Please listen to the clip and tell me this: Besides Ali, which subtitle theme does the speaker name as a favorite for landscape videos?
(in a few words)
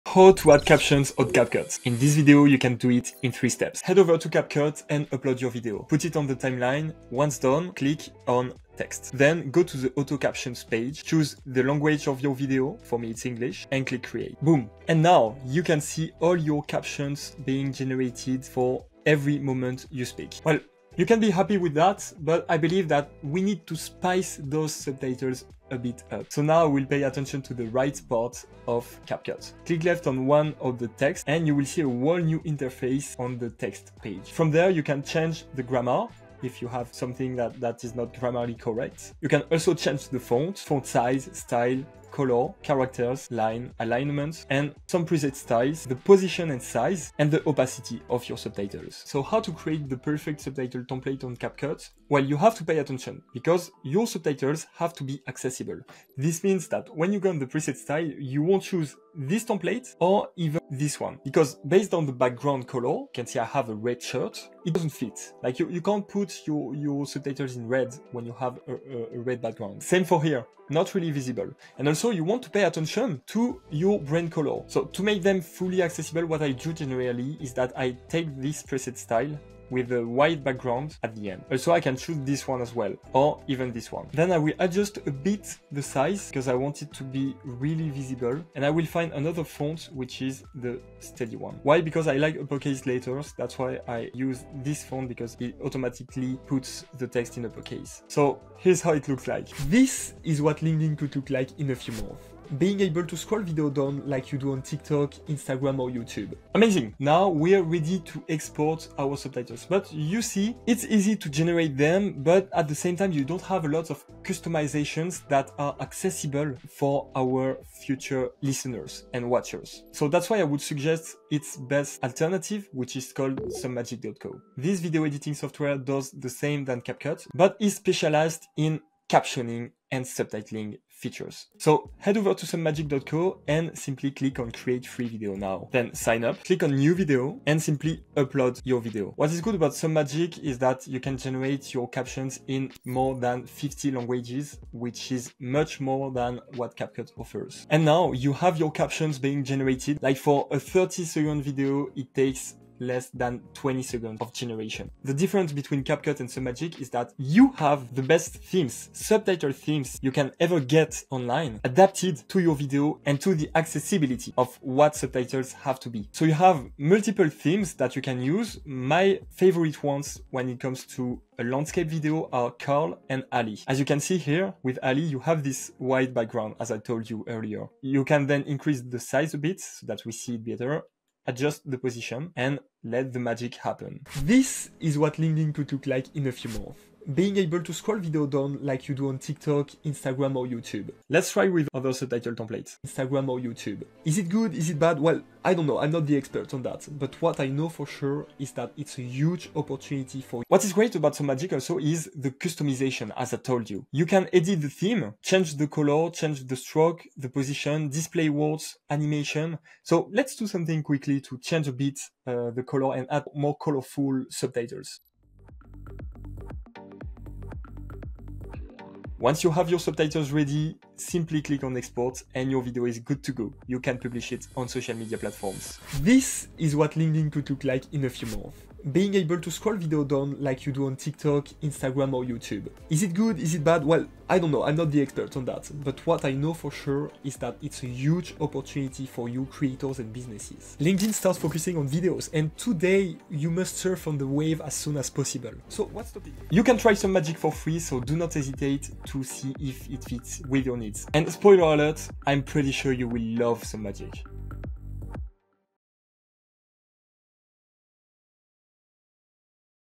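Carl.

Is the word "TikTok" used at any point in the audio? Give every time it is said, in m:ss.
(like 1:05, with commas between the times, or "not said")
1:44, 3:09, 3:50.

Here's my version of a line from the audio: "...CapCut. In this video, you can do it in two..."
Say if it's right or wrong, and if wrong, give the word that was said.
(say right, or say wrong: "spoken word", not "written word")
wrong: "three", not "two".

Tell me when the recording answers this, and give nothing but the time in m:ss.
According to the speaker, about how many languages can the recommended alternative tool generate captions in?
2:23.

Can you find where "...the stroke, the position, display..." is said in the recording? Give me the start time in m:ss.
3:26.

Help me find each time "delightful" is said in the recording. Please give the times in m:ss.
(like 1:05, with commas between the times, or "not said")
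not said.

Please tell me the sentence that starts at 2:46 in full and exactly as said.
So you have multiple themes that you can use.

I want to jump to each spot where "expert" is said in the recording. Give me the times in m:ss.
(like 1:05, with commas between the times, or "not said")
3:16, 3:55.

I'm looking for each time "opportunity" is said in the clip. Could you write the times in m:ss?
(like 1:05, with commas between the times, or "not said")
3:19, 3:58.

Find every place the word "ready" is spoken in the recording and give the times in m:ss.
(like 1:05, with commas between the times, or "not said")
1:47, 3:40.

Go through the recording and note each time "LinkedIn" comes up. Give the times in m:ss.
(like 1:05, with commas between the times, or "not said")
1:40, 3:05, 3:46, 4:00.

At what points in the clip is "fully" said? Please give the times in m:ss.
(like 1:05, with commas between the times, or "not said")
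1:15.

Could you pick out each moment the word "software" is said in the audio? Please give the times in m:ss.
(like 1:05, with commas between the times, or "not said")
2:05.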